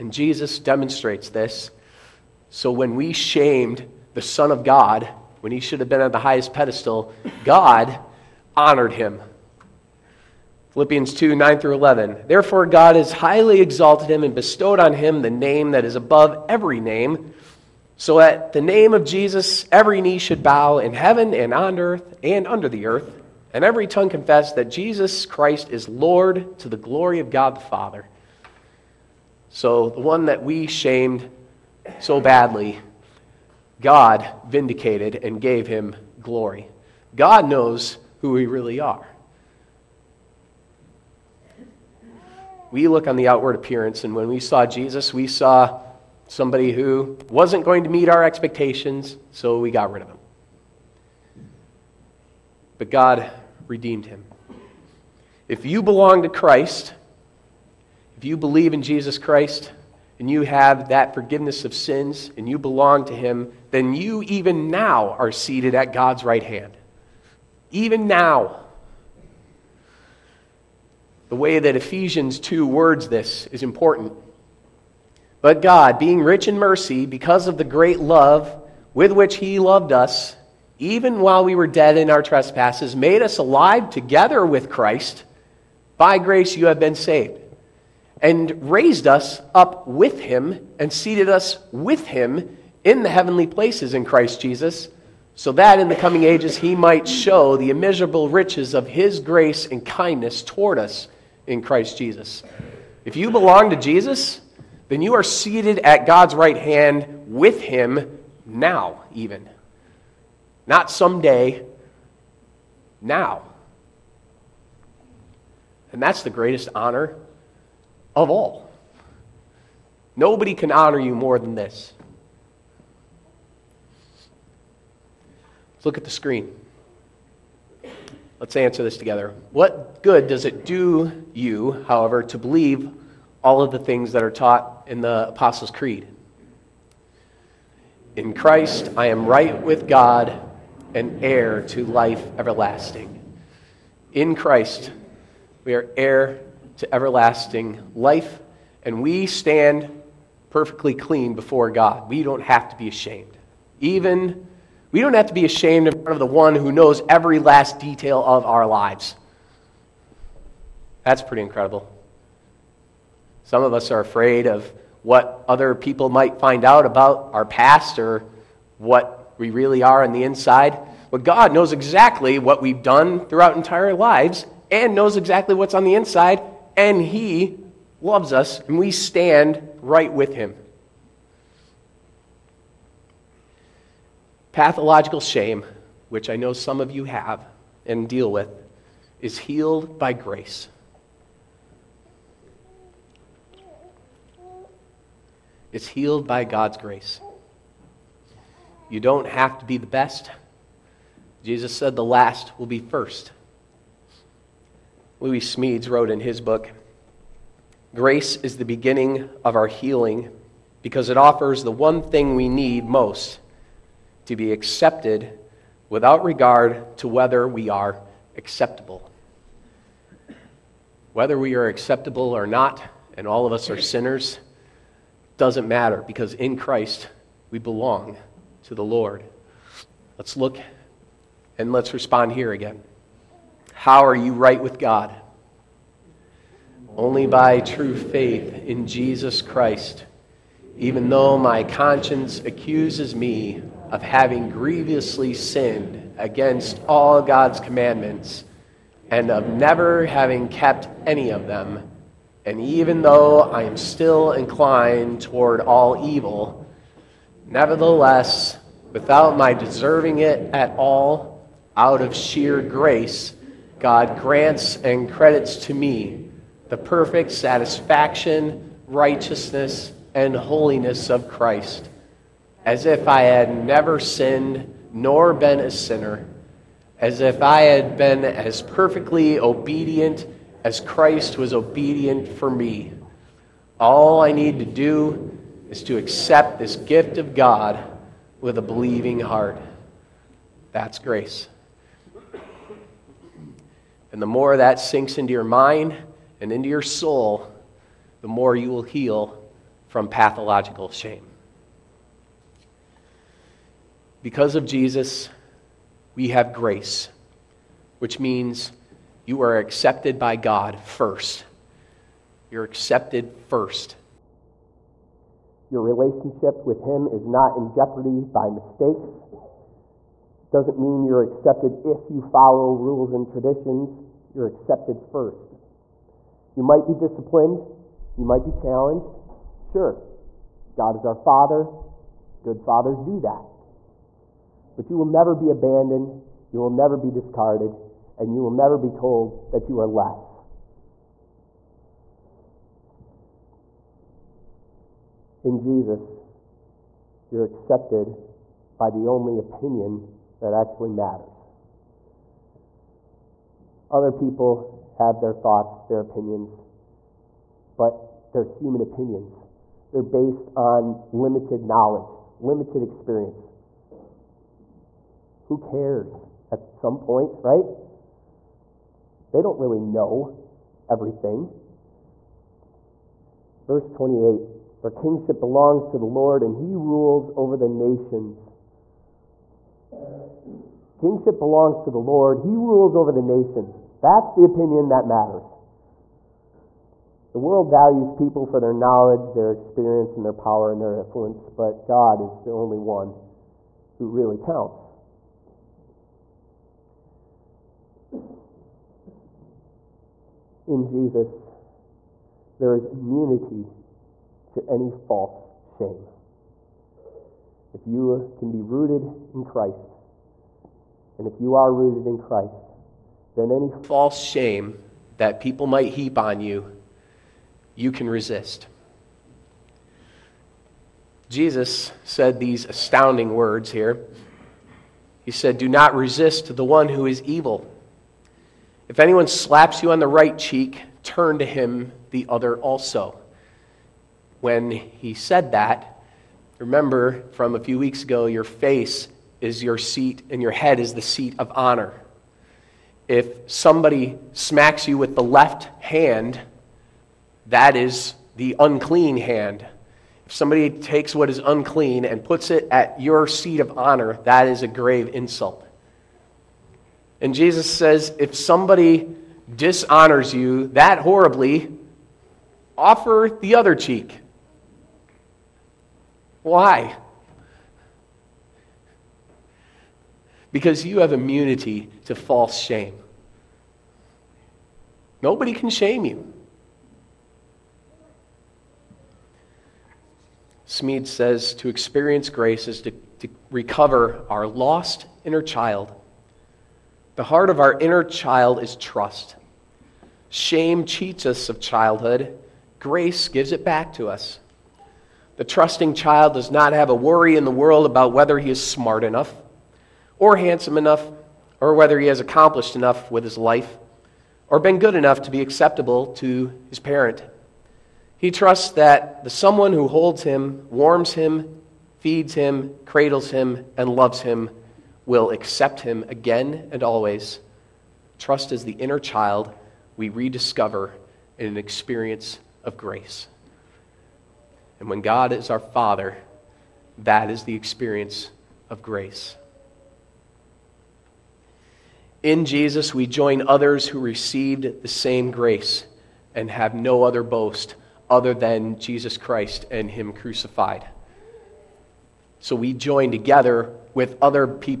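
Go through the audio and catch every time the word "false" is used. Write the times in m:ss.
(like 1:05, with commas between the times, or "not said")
6:44, 6:53, 7:52.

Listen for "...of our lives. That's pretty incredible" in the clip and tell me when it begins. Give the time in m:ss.
2:38.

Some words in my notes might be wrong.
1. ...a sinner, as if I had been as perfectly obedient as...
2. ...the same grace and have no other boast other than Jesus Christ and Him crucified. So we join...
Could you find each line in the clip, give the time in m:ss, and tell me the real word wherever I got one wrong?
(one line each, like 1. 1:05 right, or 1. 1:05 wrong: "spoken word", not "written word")
1. 4:35 right
2. 8:54 right.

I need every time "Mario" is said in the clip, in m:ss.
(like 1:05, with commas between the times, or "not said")
not said.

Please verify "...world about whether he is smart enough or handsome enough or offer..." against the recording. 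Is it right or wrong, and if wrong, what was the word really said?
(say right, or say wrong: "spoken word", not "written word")
wrong: "whether", not "offer".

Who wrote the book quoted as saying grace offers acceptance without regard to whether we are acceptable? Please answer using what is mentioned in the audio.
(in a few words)
Lewis Smedes.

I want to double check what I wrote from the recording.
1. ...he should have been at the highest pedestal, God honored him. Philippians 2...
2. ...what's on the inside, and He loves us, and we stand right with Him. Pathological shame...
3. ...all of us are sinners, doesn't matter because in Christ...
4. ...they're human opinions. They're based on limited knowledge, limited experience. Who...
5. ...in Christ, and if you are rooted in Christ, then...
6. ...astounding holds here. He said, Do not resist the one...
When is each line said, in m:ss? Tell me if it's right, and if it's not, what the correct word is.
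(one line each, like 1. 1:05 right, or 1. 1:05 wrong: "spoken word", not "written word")
1. 0:05 right
2. 2:55 right
3. 3:43 right
4. 5:58 right
5. 6:49 right
6. 7:02 wrong: "words", not "holds".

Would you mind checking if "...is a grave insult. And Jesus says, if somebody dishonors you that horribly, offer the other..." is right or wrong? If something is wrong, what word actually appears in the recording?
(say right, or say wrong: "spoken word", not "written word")
right.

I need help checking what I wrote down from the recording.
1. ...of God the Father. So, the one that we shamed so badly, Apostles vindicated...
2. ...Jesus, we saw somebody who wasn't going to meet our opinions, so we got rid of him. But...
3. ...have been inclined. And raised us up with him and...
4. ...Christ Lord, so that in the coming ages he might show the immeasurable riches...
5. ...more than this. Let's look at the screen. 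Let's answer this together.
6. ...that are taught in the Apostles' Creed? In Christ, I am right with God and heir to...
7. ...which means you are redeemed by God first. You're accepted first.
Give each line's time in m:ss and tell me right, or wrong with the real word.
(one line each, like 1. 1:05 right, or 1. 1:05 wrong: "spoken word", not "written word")
1. 0:27 wrong: "God", not "Apostles"
2. 0:44 wrong: "expectations", not "opinions"
3. 1:26 wrong: "saved", not "inclined"
4. 1:34 wrong: "Jesus", not "Lord"
5. 2:01 right
6. 2:14 right
7. 5:07 wrong: "accepted", not "redeemed".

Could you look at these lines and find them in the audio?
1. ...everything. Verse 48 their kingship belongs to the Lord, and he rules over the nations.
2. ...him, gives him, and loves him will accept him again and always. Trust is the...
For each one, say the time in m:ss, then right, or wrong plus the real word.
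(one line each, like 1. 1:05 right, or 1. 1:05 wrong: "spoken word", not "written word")
1. 6:10 wrong: "28", not "48"
2. 8:32 wrong: "cradles", not "gives".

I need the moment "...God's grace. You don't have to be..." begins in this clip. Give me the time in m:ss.
3:16.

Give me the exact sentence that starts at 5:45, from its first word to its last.
in Jesus, you're accepted by the only opinion that actually matters.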